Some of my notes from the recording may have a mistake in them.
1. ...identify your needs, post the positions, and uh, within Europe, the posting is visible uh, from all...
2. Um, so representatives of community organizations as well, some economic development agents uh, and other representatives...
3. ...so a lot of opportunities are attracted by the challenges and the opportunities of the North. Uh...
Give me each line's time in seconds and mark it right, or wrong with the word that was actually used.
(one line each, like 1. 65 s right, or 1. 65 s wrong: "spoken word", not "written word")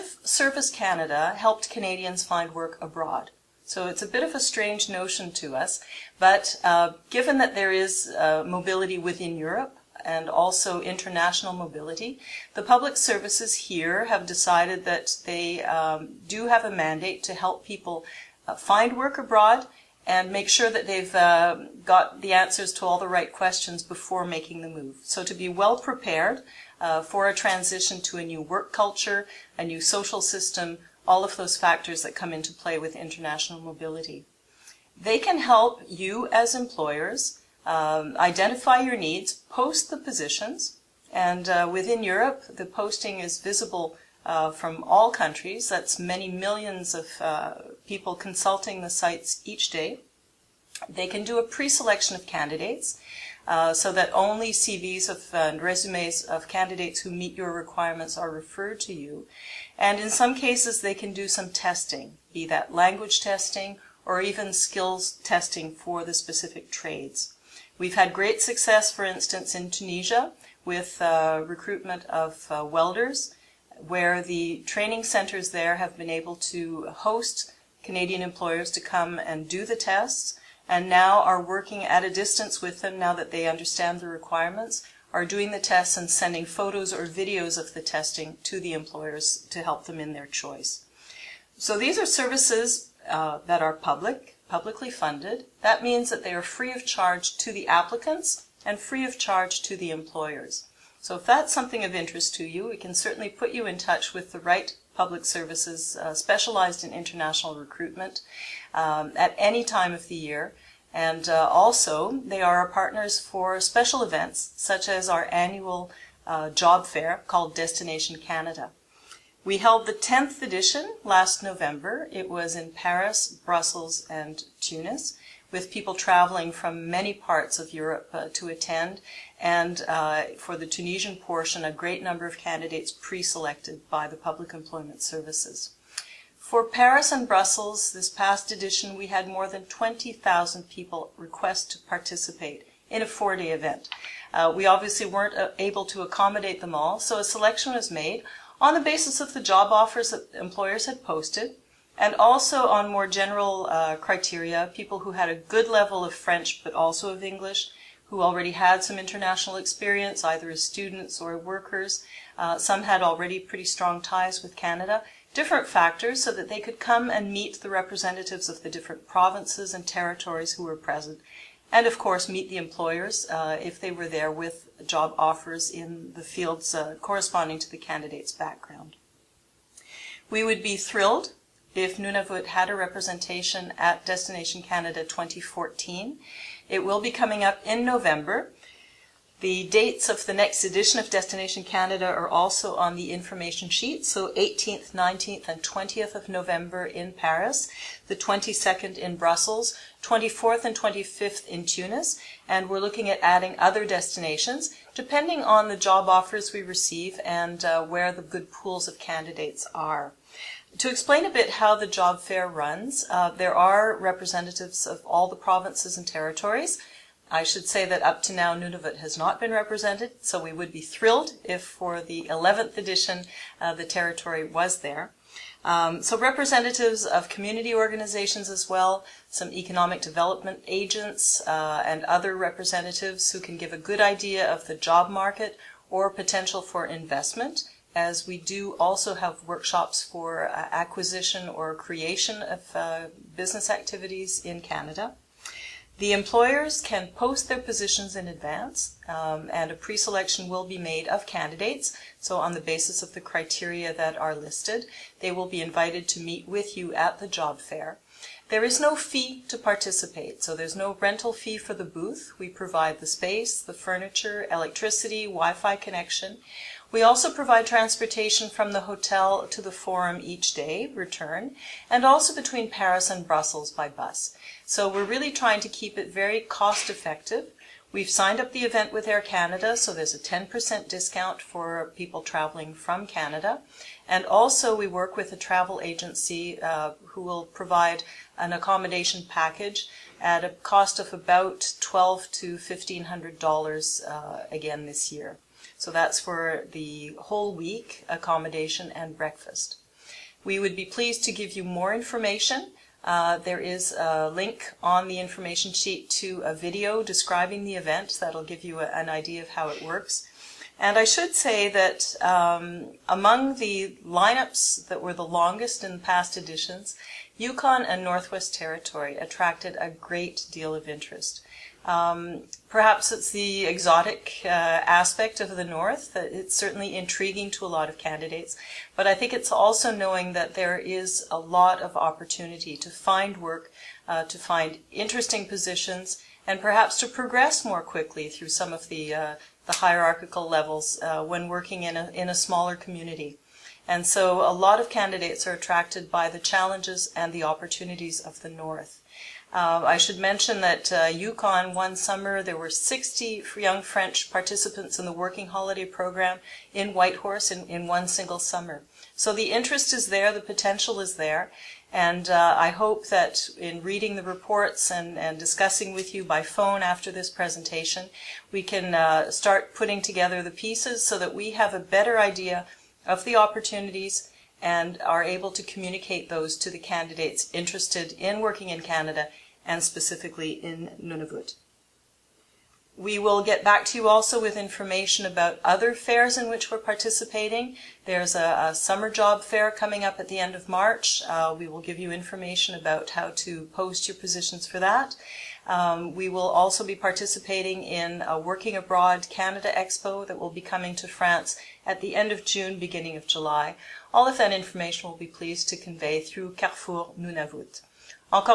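1. 38 s right
2. 225 s right
3. 344 s wrong: "candidates", not "opportunities".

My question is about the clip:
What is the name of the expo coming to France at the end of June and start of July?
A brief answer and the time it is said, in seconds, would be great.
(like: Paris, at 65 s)
Working Abroad Canada Expo, at 398 s.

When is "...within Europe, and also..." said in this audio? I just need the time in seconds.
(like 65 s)
8 s.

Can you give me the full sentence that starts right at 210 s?
To explain a bit how the job fair runs, uh, there are representatives of all the provinces and territories.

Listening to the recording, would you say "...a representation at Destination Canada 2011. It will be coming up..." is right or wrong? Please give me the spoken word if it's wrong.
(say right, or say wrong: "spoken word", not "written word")
wrong: "2014", not "2011".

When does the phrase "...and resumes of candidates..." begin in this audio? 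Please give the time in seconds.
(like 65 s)
55 s.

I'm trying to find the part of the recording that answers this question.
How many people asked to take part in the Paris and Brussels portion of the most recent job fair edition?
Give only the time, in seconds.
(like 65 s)
139 s.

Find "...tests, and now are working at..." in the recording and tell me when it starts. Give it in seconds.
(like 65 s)
79 s.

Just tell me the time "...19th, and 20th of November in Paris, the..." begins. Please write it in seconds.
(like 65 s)
194 s.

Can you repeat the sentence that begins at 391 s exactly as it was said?
Uh, we will give you information about how to post your positions for that.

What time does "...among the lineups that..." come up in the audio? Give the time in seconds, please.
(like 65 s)
313 s.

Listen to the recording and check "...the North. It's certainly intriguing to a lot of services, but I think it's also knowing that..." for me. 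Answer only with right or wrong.
wrong.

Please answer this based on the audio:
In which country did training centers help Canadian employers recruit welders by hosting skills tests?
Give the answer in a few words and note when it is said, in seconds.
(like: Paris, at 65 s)
Tunisia, at 69 s.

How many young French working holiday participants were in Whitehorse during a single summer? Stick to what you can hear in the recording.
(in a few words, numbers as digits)
60.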